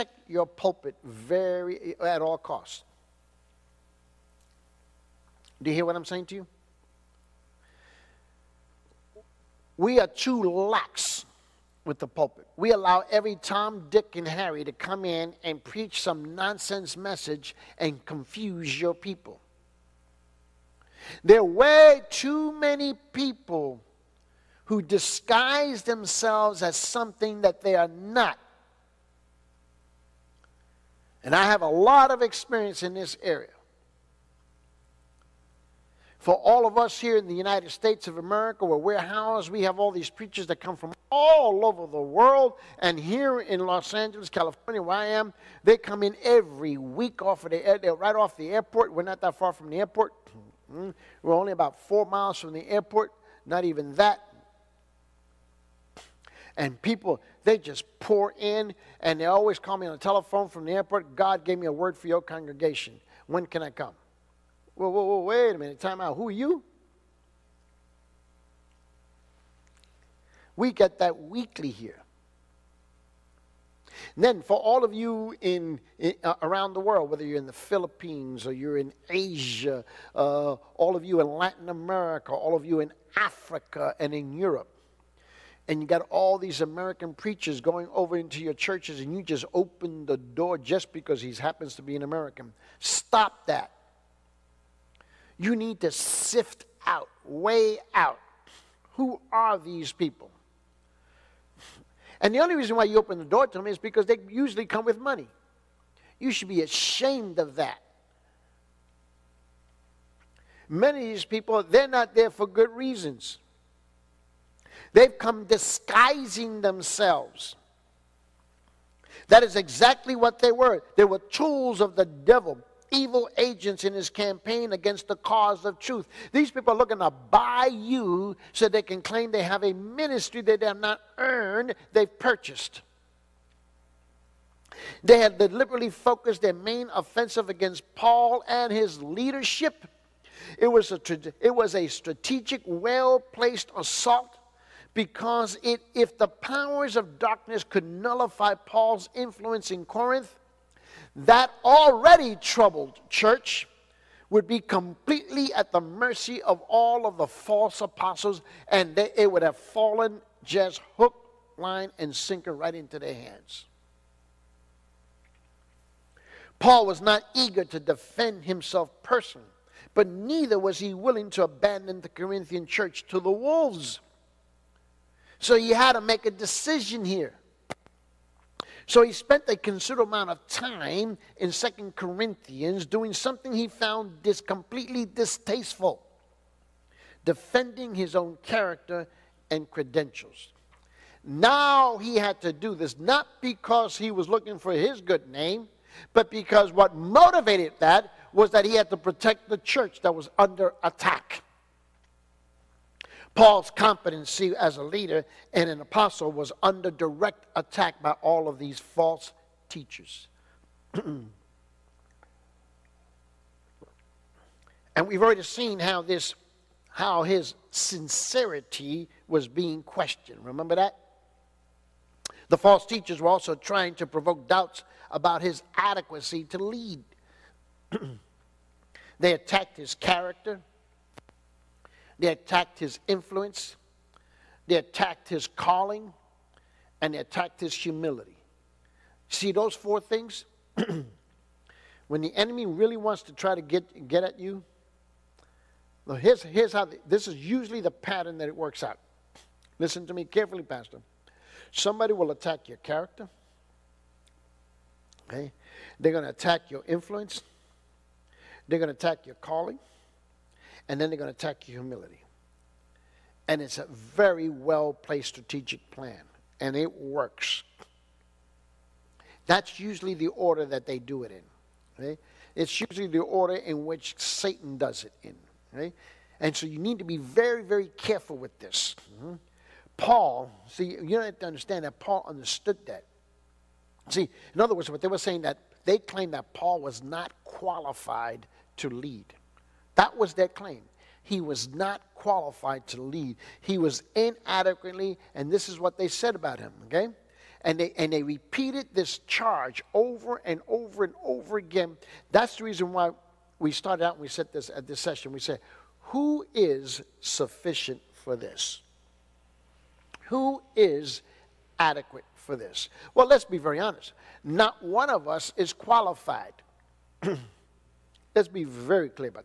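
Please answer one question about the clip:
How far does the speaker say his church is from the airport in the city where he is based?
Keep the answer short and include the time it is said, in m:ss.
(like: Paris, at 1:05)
about 4 miles, at 0:51.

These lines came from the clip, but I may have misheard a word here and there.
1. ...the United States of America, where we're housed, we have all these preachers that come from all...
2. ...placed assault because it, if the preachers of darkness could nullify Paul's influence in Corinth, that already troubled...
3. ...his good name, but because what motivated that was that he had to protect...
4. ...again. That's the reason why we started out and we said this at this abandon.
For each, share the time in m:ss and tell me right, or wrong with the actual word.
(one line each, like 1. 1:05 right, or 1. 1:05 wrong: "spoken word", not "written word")
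1. 0:37 right
2. 2:23 wrong: "powers", not "preachers"
3. 3:14 right
4. 5:01 wrong: "session", not "abandon".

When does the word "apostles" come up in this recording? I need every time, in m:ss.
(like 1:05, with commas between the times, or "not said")
2:37, 3:25.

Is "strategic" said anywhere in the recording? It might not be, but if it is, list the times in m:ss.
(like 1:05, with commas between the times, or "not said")
2:21, 4:25.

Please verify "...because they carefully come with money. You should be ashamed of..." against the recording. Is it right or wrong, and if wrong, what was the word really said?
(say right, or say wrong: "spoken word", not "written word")
wrong: "usually", not "carefully".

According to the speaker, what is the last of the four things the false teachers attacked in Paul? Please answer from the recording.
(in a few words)
his humility.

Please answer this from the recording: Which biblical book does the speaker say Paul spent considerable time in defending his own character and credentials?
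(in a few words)
Second Corinthians.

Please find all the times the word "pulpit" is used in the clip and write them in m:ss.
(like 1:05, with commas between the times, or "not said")
0:00, 0:12.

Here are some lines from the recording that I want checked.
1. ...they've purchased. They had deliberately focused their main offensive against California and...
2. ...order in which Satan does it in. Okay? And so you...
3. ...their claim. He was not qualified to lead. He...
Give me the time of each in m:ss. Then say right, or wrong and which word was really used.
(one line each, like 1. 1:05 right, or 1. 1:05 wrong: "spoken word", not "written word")
1. 2:11 wrong: "Paul", not "California"
2. 4:33 right
3. 4:50 right.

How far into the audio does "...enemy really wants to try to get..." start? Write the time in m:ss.
4:02.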